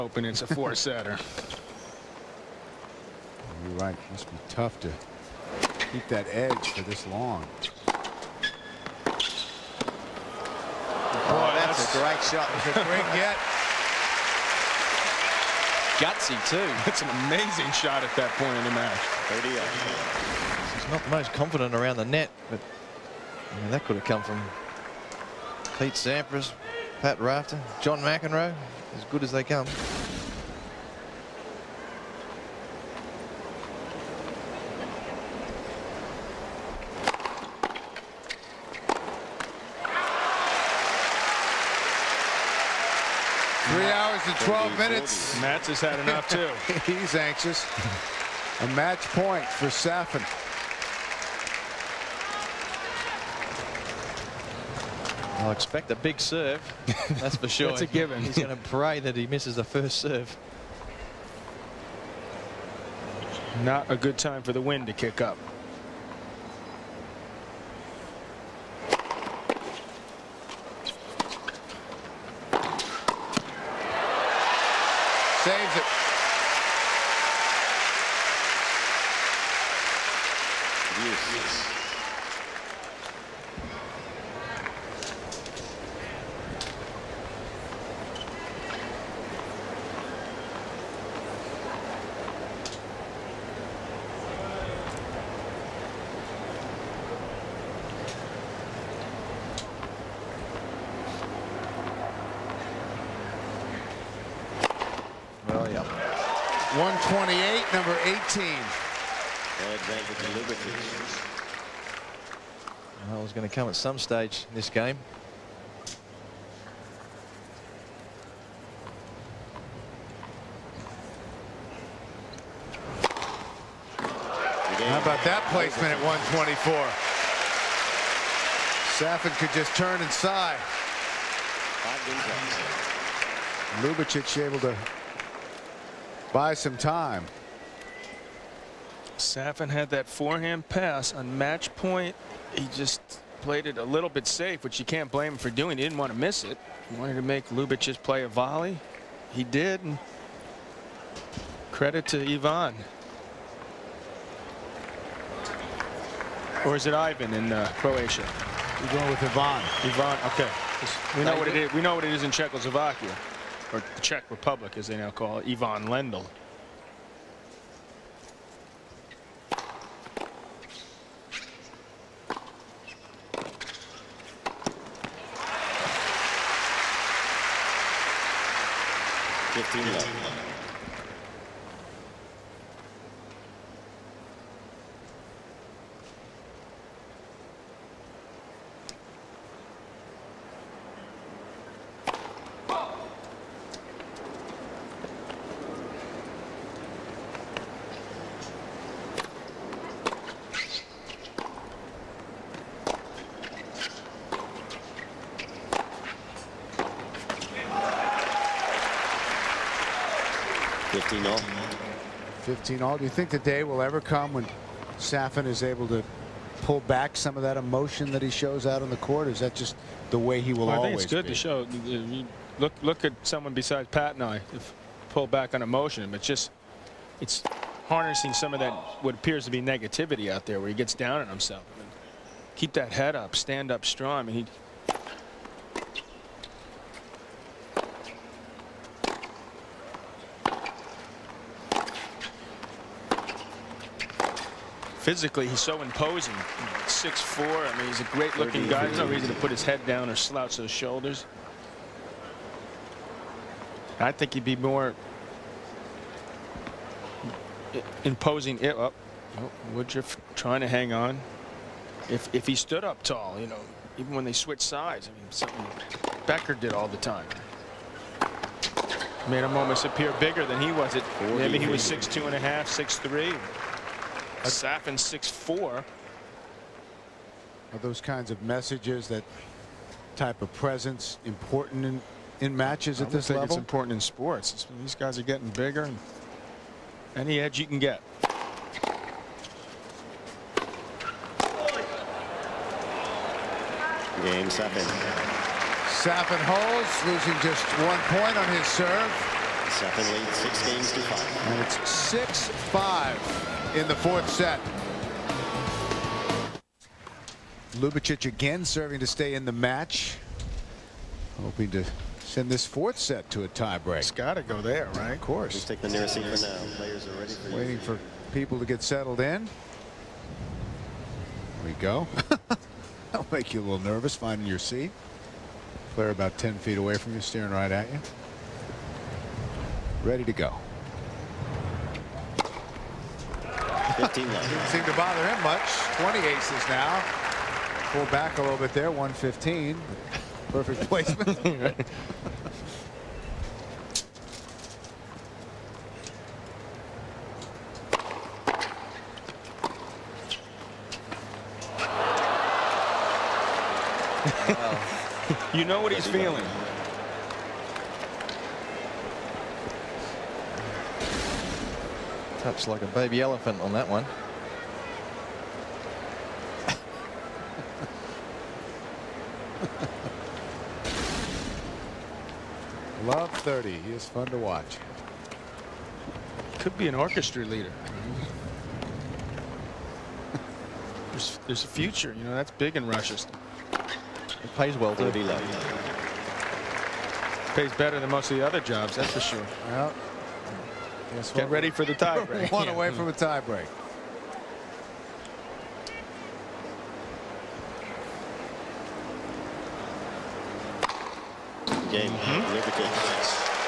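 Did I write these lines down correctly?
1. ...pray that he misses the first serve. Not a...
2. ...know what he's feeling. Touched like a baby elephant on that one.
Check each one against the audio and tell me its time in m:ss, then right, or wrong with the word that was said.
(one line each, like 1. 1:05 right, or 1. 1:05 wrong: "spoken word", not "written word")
1. 0:58 right
2. 5:55 right.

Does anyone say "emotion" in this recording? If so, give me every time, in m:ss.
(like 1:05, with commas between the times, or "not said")
3:37, 3:45.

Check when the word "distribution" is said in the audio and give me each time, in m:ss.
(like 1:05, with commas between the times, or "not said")
not said.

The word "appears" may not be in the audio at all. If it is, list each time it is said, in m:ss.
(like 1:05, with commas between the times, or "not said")
3:49, 4:29.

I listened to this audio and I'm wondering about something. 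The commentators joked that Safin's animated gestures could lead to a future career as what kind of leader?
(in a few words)
orchestra leader.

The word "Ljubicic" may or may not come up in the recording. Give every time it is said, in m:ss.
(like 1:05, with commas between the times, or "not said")
2:27, 5:07.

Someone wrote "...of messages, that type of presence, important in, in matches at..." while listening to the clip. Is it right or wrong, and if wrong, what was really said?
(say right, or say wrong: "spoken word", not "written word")
right.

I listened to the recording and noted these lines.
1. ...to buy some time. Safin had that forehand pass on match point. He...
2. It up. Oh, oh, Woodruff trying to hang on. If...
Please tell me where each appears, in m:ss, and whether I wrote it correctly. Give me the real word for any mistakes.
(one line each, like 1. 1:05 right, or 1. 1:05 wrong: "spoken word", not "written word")
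1. 2:14 right
2. 4:18 right.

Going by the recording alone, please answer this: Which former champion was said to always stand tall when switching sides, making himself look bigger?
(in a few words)
Becker.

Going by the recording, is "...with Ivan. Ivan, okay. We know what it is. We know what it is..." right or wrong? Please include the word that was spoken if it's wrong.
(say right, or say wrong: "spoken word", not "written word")
right.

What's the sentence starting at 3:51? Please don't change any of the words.
I mean, keep that head up, stand up strong.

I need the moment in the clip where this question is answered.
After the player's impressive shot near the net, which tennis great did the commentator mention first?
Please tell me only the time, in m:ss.
0:25.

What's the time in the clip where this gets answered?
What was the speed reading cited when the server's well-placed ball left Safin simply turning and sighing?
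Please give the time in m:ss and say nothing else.
2:06.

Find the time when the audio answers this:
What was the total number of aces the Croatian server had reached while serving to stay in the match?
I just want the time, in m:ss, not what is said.
5:35.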